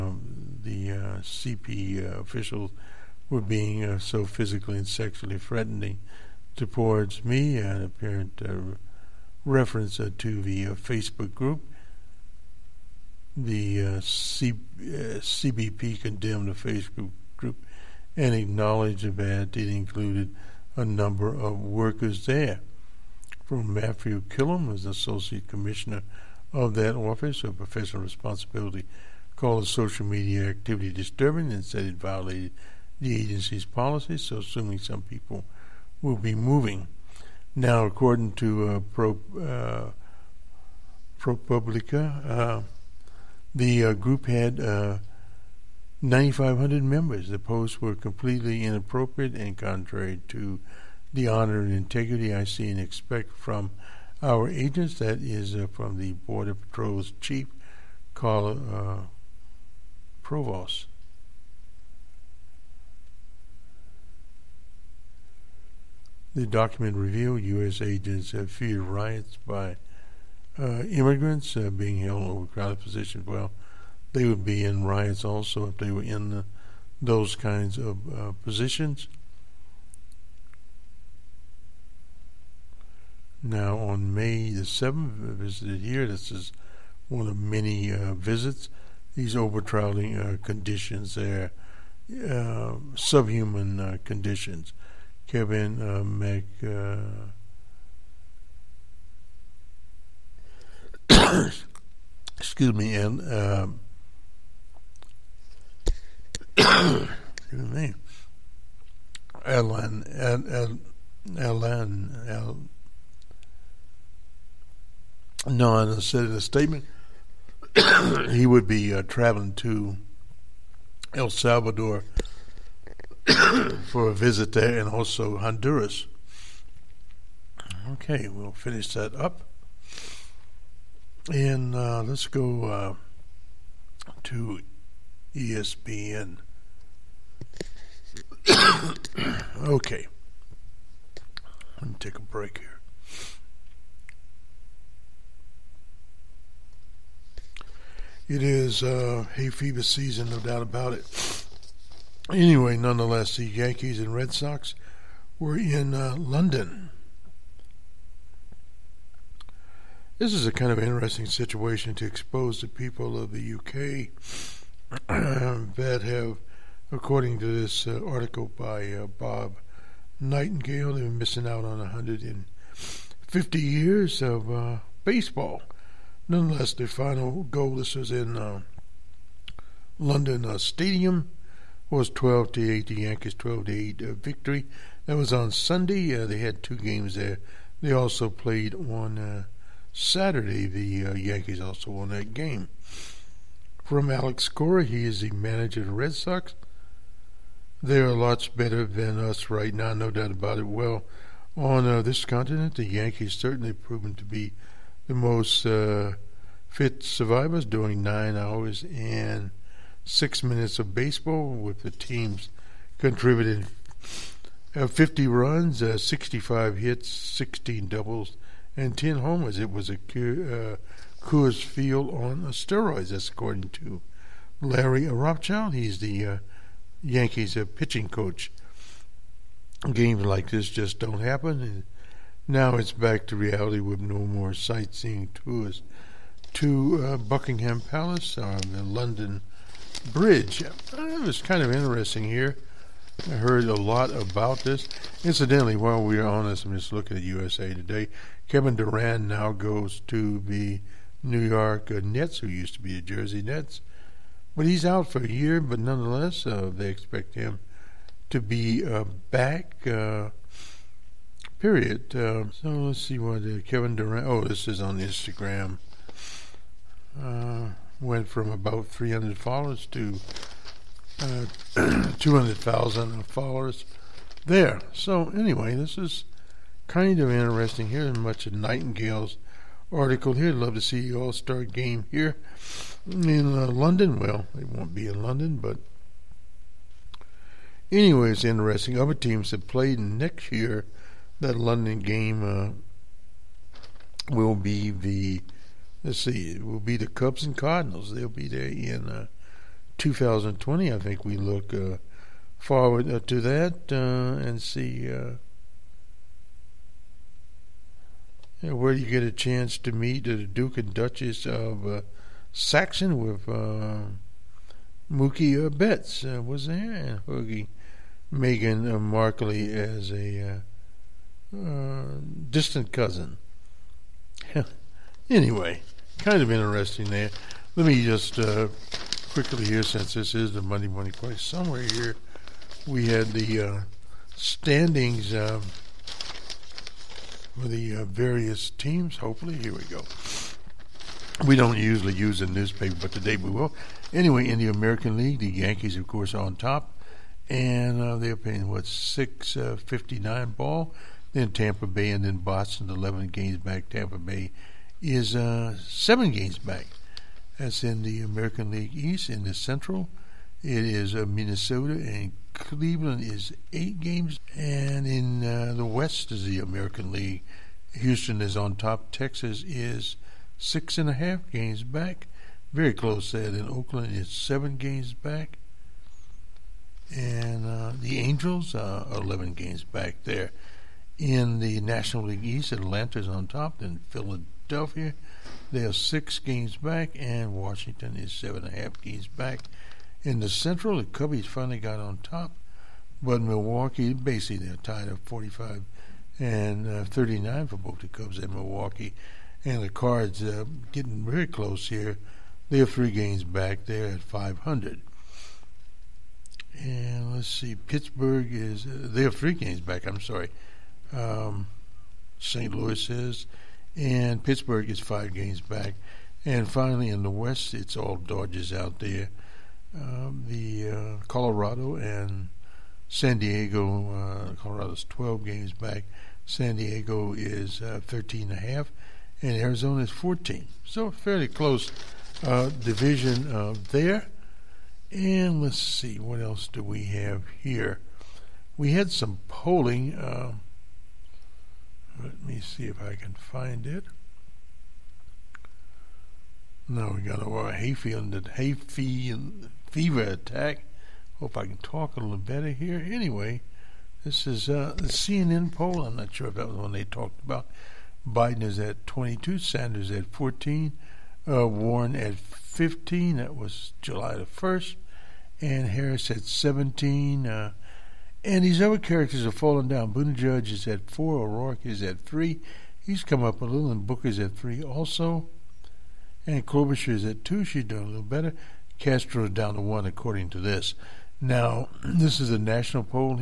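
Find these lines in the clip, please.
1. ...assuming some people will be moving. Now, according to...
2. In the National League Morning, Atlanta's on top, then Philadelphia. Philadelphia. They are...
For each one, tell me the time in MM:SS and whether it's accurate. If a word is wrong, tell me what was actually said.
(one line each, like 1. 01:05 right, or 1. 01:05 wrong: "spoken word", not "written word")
1. 00:34 right
2. 06:21 wrong: "East", not "Morning".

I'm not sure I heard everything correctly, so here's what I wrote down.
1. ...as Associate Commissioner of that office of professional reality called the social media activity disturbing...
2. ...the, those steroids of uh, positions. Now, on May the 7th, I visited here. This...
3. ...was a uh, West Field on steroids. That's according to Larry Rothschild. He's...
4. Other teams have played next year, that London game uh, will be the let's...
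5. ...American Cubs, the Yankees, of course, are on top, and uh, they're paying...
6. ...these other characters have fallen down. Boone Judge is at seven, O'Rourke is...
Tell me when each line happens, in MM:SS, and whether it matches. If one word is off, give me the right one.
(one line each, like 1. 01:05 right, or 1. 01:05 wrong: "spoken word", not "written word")
1. 00:24 wrong: "responsibility", not "reality"
2. 01:16 wrong: "kinds", not "steroids"
3. 03:39 wrong: "Coors", not "West"
4. 04:48 right
5. 05:44 wrong: "League", not "Cubs"
6. 07:48 wrong: "four", not "seven".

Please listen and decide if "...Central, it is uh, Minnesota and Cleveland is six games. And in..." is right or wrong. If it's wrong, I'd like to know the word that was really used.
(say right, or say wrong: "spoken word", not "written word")
wrong: "eight", not "six".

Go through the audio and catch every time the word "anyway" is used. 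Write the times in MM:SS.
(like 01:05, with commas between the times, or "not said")
02:32, 04:35, 04:47, 05:25, 05:44, 07:33.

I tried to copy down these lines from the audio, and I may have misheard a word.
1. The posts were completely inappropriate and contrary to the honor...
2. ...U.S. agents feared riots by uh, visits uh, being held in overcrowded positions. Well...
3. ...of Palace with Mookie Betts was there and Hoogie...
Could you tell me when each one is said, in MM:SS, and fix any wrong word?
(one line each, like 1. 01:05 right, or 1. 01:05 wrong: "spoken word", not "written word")
1. 00:47 right
2. 01:07 wrong: "immigrants", not "visits"
3. 05:11 wrong: "Saxon", not "Palace".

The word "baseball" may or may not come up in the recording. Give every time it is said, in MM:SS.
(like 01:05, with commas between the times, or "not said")
02:55, 03:30.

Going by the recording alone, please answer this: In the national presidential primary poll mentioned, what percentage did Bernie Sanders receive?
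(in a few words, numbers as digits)
14.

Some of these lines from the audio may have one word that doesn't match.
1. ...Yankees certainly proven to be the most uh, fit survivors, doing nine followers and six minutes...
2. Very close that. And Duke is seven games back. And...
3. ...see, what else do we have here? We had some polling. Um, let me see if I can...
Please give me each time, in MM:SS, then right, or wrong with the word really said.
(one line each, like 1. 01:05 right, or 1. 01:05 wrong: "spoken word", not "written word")
1. 03:22 wrong: "hours", not "followers"
2. 06:12 wrong: "Oakland", not "Duke"
3. 07:15 right.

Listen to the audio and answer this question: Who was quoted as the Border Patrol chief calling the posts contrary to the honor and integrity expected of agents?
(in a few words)
Carl Provost.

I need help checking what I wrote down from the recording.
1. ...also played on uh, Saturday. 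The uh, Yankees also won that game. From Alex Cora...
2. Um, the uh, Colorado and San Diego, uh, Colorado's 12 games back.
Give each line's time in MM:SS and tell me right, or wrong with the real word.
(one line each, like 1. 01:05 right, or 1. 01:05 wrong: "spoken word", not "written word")
1. 03:07 right
2. 06:59 right.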